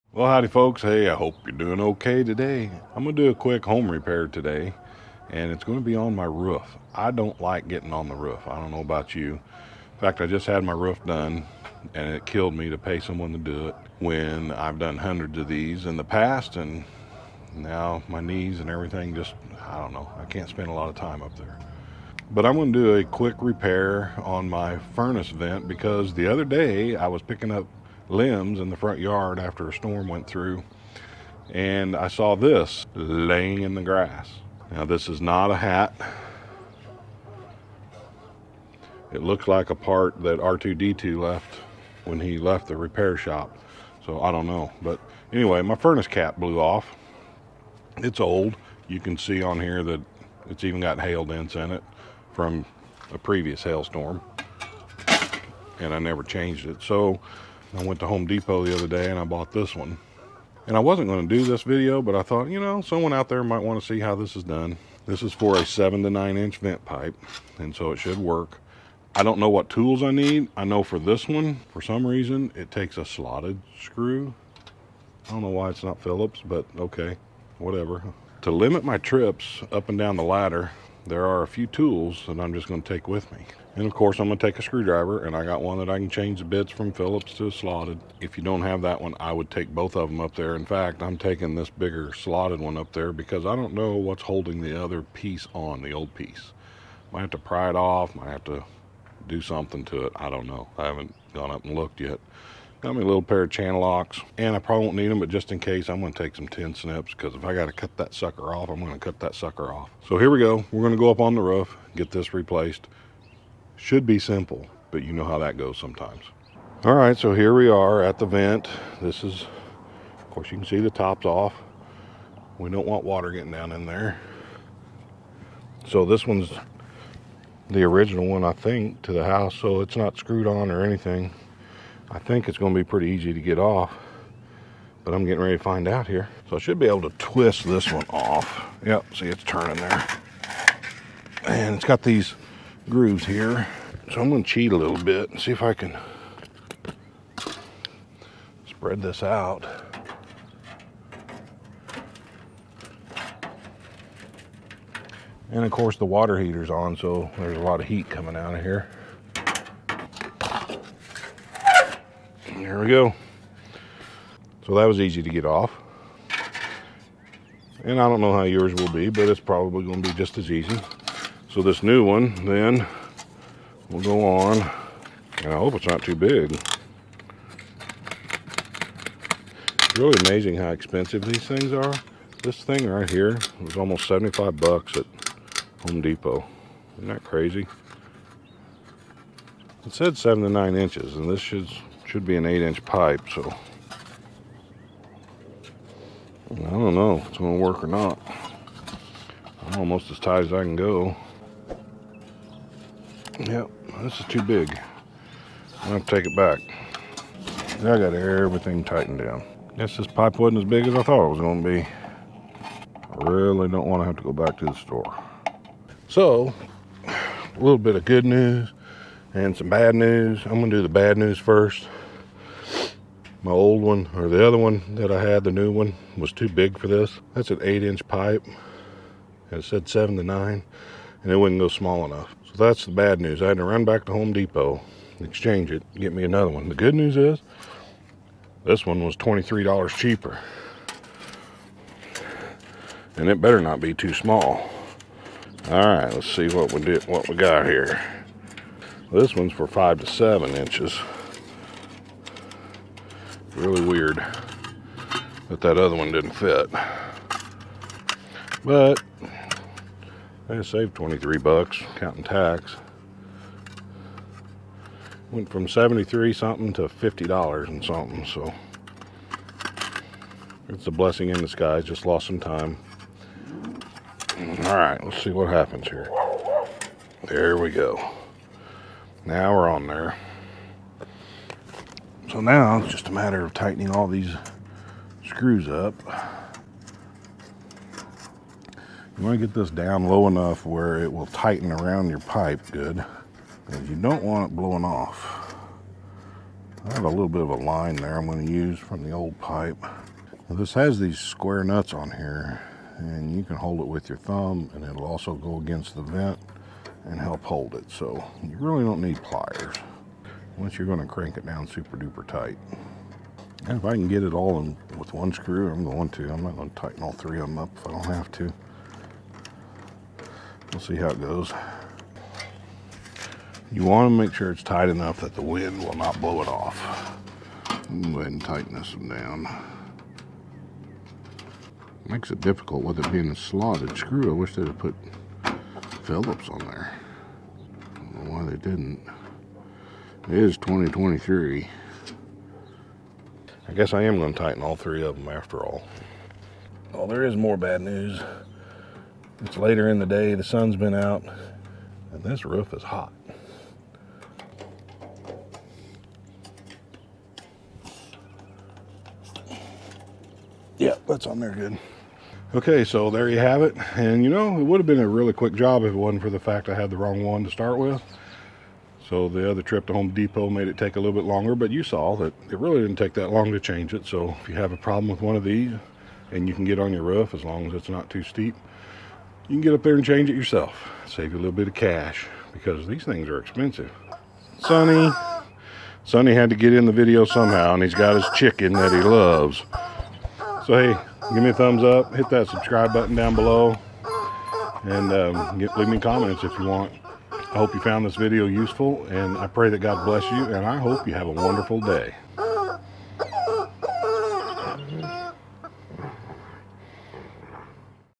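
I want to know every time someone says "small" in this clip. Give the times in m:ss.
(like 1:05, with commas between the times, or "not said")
3:51, 4:04.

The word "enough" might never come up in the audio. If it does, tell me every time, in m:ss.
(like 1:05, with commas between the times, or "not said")
3:52, 4:50, 5:24.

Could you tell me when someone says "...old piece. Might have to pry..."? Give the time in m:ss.
1:35.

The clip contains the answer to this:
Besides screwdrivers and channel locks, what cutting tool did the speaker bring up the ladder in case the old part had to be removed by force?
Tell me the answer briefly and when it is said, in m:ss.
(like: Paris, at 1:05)
tin snips, at 1:46.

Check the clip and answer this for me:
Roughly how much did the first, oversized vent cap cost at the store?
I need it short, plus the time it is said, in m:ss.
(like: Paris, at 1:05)
$75, at 3:04.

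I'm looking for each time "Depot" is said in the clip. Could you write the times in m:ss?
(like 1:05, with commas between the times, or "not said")
0:58, 3:05, 3:54, 6:10.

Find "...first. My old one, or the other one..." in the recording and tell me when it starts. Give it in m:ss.
3:41.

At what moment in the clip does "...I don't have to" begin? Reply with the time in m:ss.
5:17.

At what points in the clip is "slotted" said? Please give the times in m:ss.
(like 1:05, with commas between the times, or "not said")
1:13, 1:27, 1:32, 5:33.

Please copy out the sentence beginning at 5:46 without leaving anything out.
Well, there is more bad news.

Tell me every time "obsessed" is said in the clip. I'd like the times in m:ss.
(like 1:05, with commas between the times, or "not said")
not said.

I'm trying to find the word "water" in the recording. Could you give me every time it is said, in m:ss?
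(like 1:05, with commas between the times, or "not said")
2:03, 2:36.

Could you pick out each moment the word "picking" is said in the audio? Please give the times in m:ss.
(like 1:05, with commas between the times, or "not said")
0:27.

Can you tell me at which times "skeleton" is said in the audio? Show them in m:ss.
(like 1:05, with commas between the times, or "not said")
not said.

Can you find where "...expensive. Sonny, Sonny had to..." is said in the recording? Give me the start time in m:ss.
6:23.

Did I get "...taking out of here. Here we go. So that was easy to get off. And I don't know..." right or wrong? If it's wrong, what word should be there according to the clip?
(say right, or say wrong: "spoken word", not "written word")
wrong: "coming", not "taking".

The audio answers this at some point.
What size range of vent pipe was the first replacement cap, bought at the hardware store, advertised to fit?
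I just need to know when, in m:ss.
1:05.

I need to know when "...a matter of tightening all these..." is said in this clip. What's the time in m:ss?
4:43.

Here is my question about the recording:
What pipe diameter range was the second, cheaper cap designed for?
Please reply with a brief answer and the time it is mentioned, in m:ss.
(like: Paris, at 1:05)
5 to 7 inches, at 4:09.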